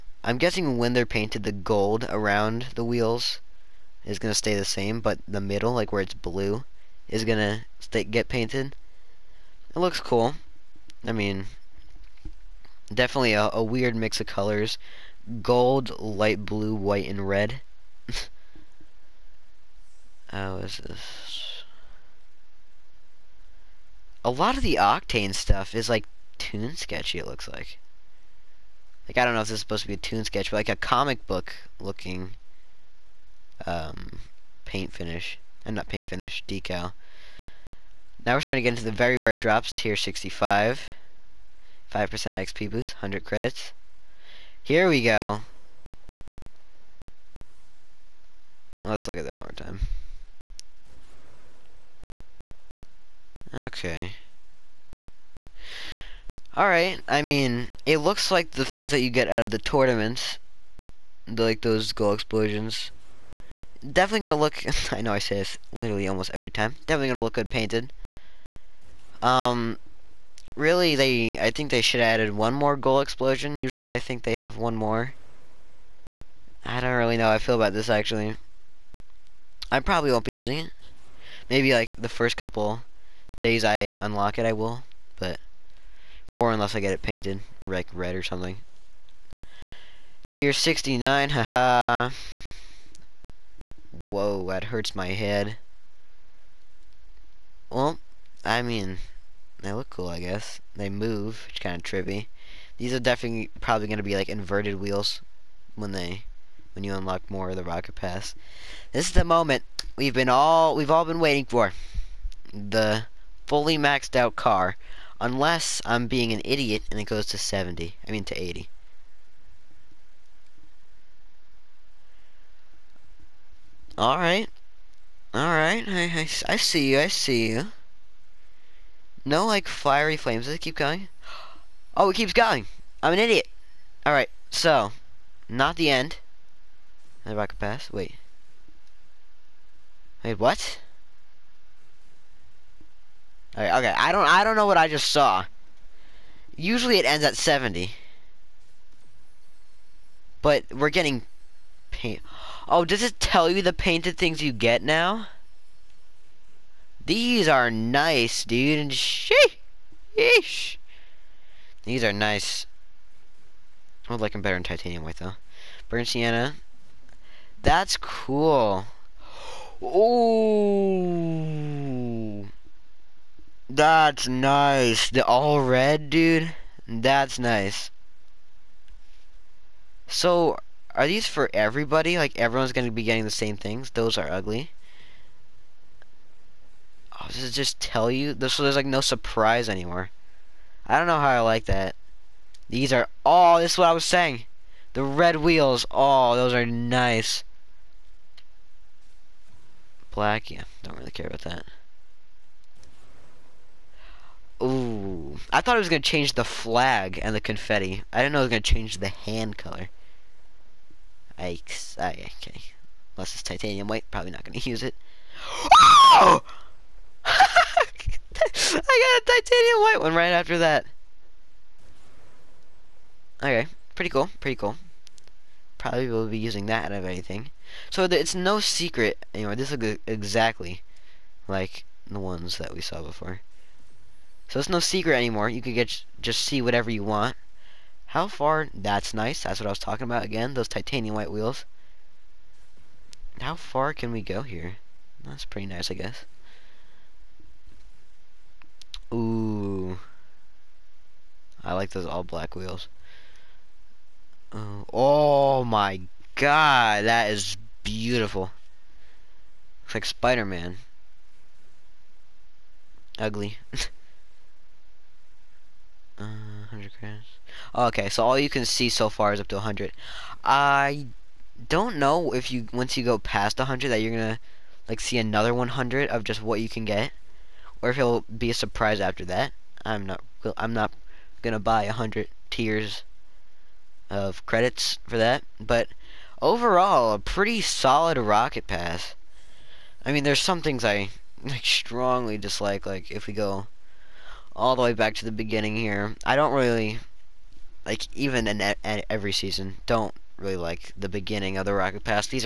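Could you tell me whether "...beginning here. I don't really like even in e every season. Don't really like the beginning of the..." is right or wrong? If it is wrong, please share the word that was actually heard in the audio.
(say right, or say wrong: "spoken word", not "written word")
right.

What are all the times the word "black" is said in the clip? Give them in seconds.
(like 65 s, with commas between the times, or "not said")
200 s, 252 s.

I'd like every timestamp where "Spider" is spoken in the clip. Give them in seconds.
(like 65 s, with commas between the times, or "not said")
260 s.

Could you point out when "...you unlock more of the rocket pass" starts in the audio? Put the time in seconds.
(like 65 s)
106 s.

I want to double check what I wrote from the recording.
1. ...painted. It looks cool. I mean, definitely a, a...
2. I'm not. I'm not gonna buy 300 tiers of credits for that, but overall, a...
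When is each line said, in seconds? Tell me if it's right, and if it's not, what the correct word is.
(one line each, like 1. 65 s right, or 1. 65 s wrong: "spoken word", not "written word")
1. 8 s right
2. 279 s wrong: "100", not "300".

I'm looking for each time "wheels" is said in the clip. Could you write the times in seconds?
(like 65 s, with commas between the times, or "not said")
2 s, 104 s, 195 s, 241 s, 252 s.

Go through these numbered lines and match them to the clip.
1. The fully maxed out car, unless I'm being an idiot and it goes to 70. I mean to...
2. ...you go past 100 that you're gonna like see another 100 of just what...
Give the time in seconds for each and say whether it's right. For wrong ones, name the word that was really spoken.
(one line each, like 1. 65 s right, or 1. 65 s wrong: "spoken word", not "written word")
1. 112 s right
2. 272 s right.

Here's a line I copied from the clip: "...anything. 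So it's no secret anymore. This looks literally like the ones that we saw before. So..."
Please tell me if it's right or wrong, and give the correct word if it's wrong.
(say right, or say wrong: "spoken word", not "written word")
wrong: "exactly", not "literally".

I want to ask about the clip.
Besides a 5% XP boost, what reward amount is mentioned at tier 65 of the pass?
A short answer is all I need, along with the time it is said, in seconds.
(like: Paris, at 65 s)
100 credits, at 42 s.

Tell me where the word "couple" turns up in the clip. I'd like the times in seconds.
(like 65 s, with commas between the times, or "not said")
82 s.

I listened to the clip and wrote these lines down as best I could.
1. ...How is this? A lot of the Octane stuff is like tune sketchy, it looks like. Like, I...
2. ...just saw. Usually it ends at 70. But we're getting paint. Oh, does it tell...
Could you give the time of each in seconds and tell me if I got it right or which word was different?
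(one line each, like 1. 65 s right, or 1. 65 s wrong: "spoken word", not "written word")
1. 20 s right
2. 144 s right.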